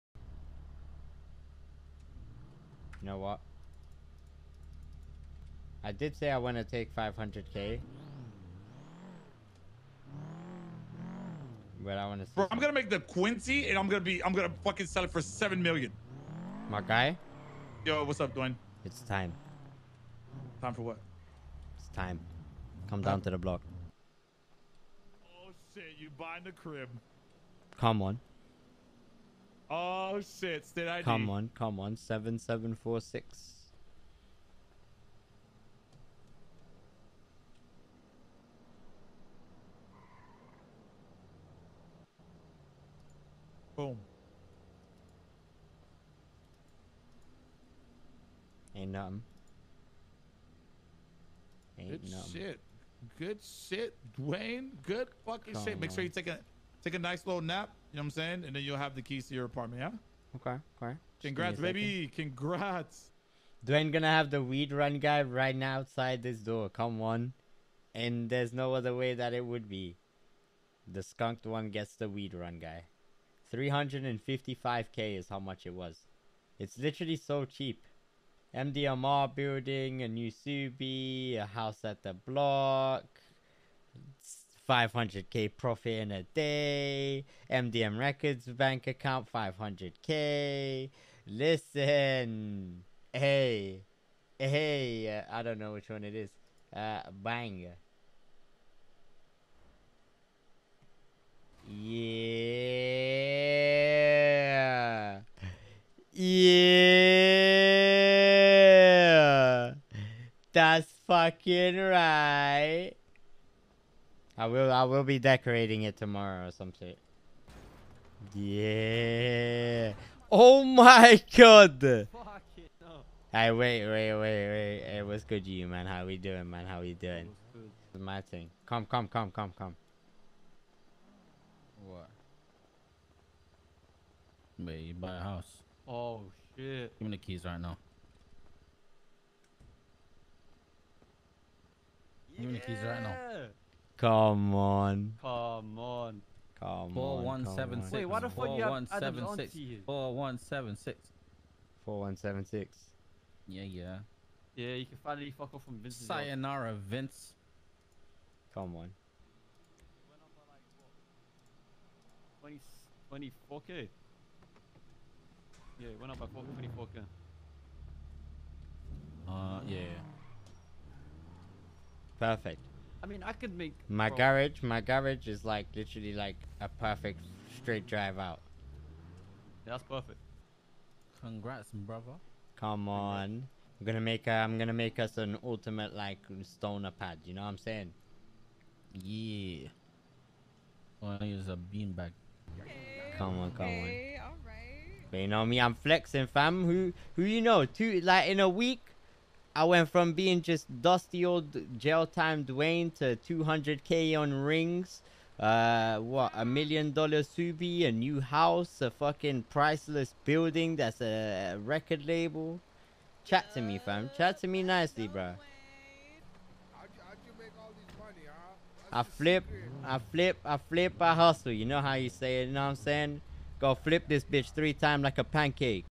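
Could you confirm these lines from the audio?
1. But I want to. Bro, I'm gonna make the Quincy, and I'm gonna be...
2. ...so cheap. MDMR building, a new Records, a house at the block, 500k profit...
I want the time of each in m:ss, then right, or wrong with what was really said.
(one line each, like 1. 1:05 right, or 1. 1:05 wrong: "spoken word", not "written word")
1. 0:11 right
2. 1:17 wrong: "Subi", not "Records".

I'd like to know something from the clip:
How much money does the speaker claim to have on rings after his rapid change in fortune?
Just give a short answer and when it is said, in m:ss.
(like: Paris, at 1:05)
200k, at 3:23.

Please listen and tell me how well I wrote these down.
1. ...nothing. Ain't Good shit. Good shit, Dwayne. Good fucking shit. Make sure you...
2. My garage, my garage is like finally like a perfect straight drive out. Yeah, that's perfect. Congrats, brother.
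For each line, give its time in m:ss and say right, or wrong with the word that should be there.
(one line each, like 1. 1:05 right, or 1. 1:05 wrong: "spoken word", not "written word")
1. 0:48 right
2. 2:53 wrong: "literally", not "finally".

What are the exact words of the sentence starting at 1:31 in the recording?
Listen, hey, hey, uh, I don't know which one it is.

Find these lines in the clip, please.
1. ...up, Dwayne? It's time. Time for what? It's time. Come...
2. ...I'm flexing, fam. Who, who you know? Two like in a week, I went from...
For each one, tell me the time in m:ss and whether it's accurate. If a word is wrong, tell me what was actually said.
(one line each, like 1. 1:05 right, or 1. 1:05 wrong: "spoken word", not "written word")
1. 0:18 right
2. 3:15 right.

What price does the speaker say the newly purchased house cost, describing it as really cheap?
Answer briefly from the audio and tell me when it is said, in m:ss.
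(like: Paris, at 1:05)
355k, at 1:13.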